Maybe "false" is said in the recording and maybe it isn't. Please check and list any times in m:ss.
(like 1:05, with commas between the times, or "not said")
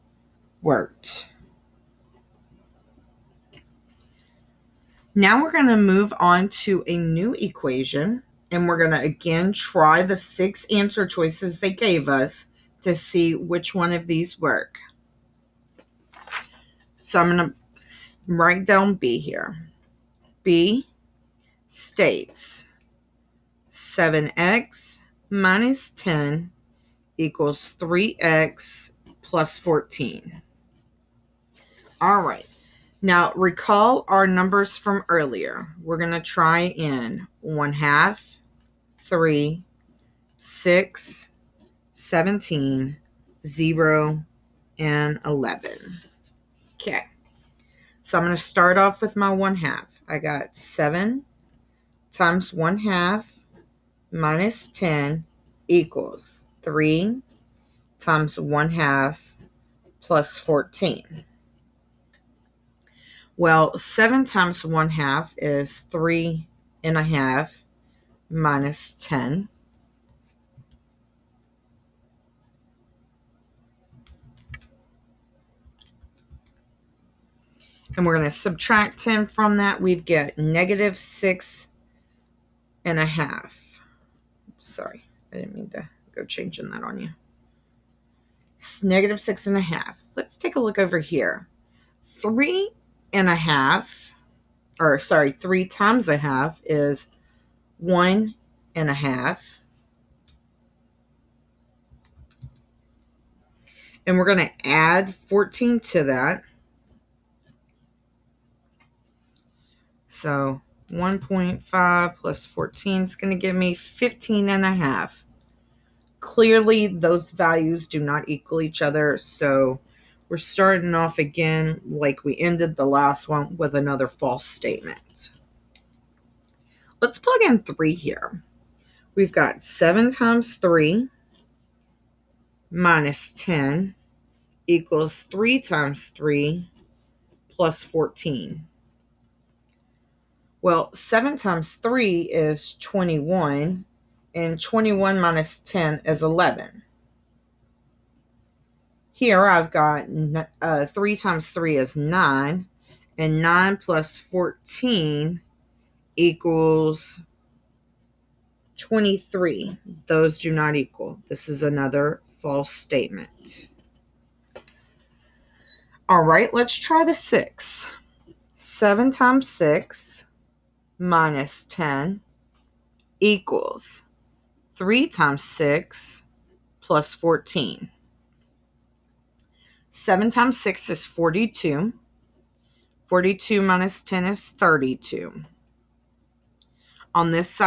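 2:04, 2:42.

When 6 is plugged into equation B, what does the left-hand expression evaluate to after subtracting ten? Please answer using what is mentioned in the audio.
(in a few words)
32.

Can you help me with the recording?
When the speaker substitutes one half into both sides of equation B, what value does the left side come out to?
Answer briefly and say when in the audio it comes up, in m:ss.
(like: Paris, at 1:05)
-6.5, at 1:28.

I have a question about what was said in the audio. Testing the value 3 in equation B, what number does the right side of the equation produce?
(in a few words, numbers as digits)
23.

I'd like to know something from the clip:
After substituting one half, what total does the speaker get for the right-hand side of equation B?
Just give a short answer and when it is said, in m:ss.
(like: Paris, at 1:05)
15.5, at 1:53.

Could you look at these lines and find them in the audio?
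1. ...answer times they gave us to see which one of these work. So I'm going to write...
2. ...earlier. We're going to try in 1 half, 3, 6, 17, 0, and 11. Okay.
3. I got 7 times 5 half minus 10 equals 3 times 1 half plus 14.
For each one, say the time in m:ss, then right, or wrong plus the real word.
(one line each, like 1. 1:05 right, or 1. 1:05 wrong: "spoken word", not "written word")
1. 0:10 wrong: "choices", not "times"
2. 0:35 right
3. 0:50 wrong: "1", not "5".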